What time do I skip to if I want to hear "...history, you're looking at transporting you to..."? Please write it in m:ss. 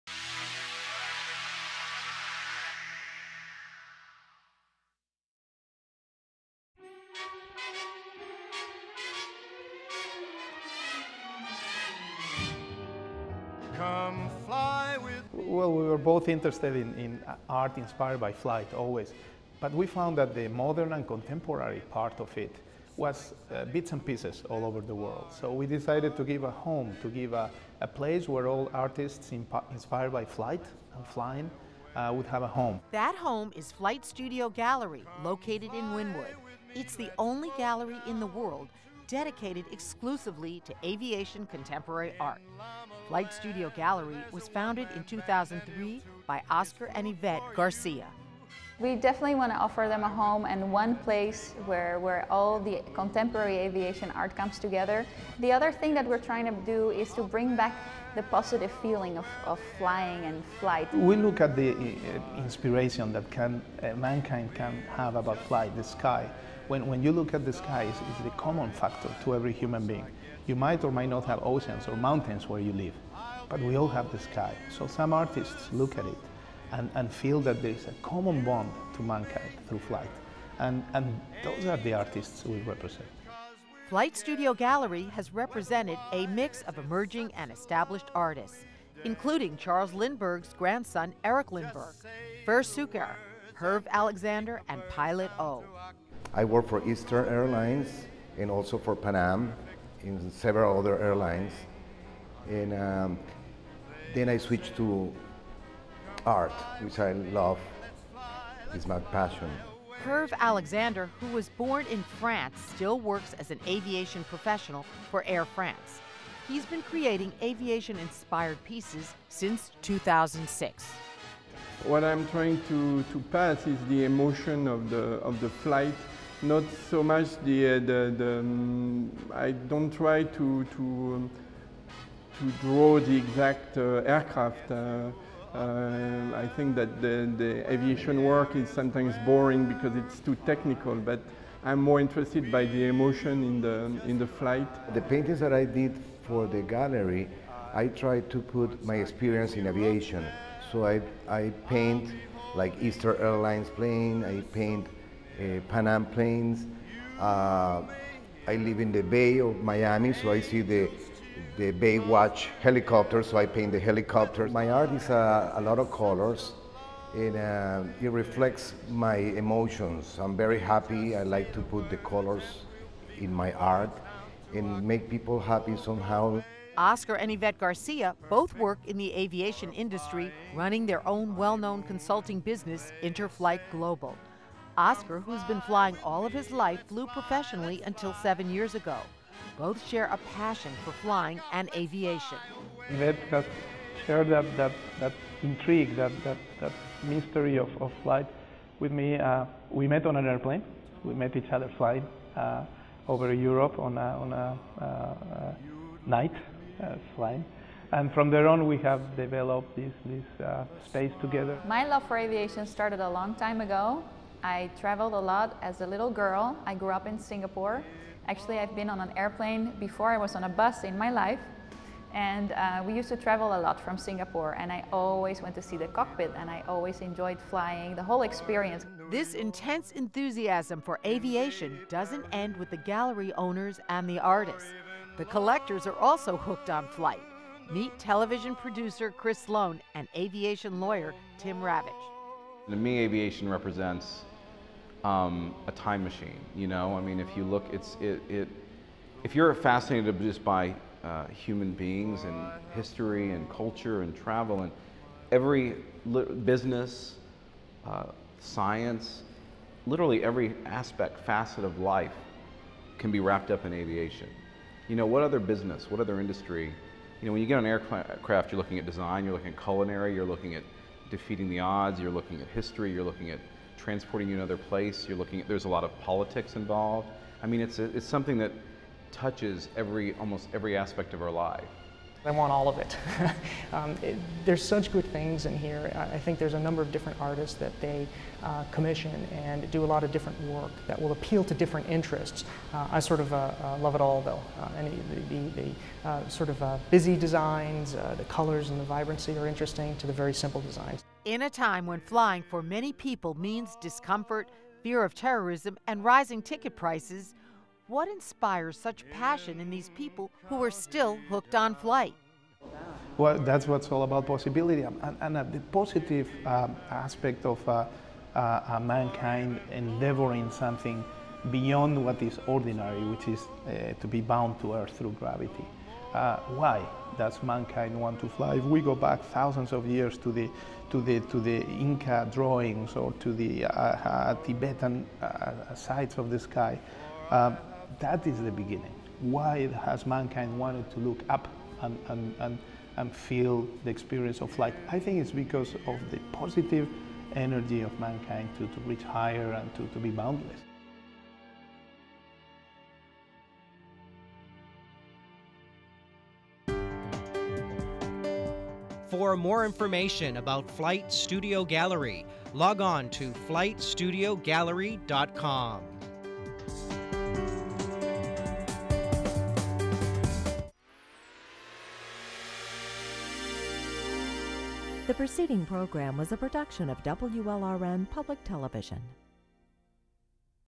4:32.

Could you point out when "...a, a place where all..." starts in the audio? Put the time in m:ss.
0:27.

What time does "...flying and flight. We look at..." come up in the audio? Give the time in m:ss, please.
0:59.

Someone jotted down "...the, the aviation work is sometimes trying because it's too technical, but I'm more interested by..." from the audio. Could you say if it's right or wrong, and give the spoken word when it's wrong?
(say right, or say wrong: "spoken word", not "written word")
wrong: "boring", not "trying".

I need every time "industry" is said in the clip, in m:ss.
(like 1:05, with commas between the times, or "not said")
2:59, 4:26.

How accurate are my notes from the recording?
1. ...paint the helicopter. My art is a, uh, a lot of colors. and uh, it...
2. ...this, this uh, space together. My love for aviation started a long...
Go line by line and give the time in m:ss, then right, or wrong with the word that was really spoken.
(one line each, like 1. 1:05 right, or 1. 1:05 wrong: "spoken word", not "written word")
1. 2:43 right
2. 3:29 right.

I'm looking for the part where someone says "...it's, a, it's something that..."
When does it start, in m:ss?
4:37.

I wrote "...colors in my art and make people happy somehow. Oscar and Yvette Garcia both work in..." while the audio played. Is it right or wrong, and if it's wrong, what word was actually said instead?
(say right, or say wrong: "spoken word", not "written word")
right.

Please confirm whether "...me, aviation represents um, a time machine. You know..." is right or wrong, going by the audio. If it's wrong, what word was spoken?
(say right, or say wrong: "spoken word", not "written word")
right.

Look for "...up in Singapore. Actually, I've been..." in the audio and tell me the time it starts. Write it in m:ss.
3:36.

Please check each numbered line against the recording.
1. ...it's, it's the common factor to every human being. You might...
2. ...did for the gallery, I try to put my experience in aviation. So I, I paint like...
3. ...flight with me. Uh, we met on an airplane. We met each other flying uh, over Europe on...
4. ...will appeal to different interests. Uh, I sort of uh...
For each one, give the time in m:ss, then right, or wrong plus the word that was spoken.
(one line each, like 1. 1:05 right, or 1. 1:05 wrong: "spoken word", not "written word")
1. 1:07 right
2. 2:25 right
3. 3:18 right
4. 4:51 right.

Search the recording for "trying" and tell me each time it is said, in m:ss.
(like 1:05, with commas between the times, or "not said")
0:56, 2:02.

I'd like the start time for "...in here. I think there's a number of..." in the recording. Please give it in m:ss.
4:45.